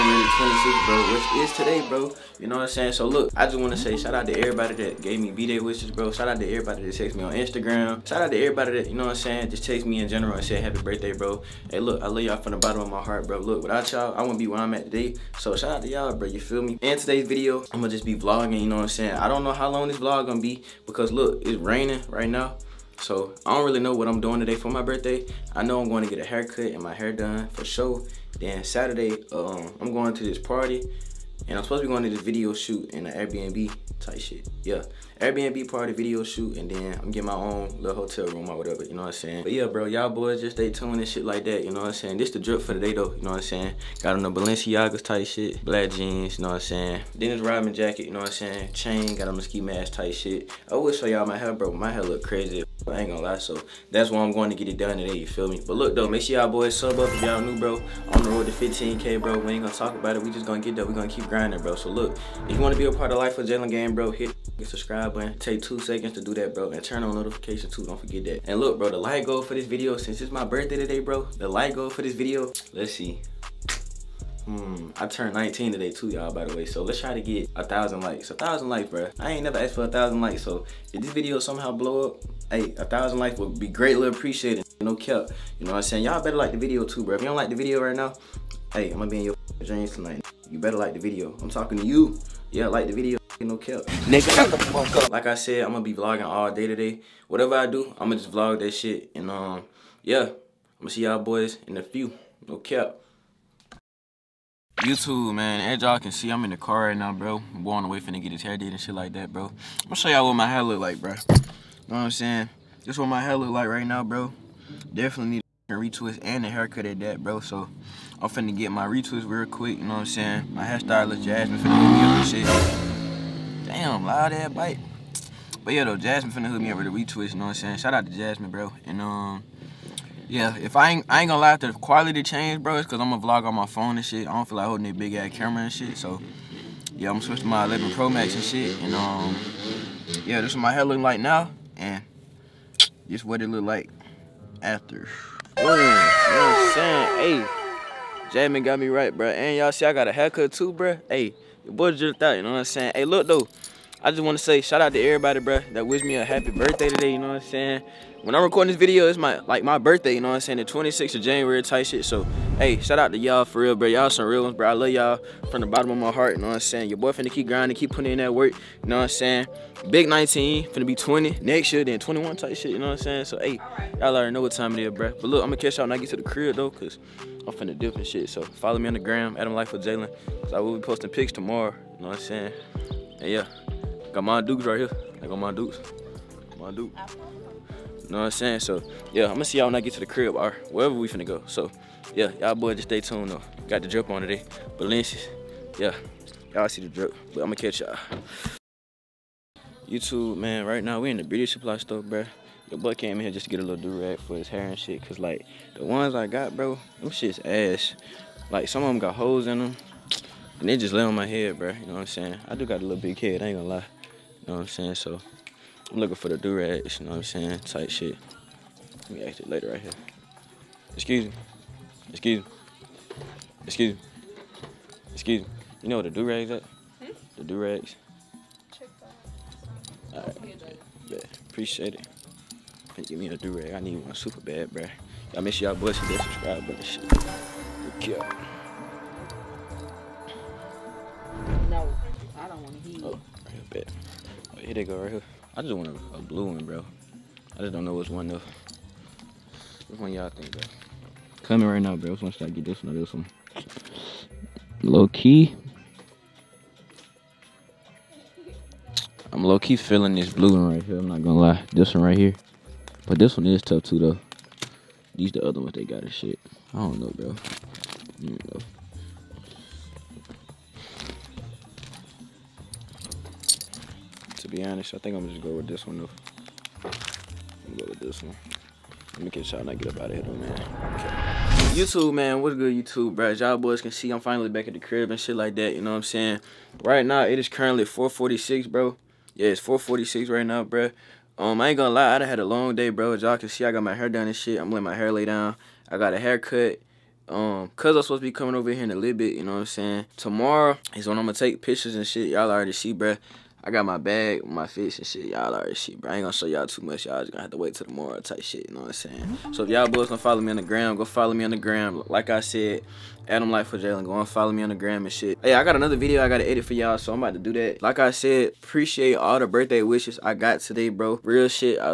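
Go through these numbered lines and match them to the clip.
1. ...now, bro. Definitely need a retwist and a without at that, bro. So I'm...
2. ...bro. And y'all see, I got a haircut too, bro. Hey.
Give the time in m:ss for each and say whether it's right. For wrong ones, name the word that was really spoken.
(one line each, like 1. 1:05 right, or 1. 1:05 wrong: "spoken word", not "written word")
1. 1:53 wrong: "haircut", not "without"
2. 2:29 right.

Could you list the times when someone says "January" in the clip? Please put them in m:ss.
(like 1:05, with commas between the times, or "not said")
0:00, 2:41.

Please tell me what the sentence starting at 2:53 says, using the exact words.
So, hey, y'all already know what time it is, bro.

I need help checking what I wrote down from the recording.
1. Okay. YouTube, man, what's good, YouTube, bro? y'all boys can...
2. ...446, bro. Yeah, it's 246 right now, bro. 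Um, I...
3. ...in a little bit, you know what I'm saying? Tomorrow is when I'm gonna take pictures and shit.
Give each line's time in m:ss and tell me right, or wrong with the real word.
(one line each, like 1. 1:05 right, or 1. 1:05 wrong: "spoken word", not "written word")
1. 4:40 right
2. 4:47 wrong: "446", not "246"
3. 4:58 right.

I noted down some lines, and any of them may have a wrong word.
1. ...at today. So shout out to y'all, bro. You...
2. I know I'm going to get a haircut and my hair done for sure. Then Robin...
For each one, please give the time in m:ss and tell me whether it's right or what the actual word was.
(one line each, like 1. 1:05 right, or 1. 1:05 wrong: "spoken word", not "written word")
1. 0:14 right
2. 0:25 wrong: "Saturday", not "Robin".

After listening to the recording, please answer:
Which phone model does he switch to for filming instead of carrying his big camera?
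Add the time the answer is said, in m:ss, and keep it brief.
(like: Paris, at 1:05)
iPhone 11 Pro Max, at 2:17.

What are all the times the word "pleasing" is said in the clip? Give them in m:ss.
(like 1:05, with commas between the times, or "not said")
not said.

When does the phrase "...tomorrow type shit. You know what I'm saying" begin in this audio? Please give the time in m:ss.
5:07.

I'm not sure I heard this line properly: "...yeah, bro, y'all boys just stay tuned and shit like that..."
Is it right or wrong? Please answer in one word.
right.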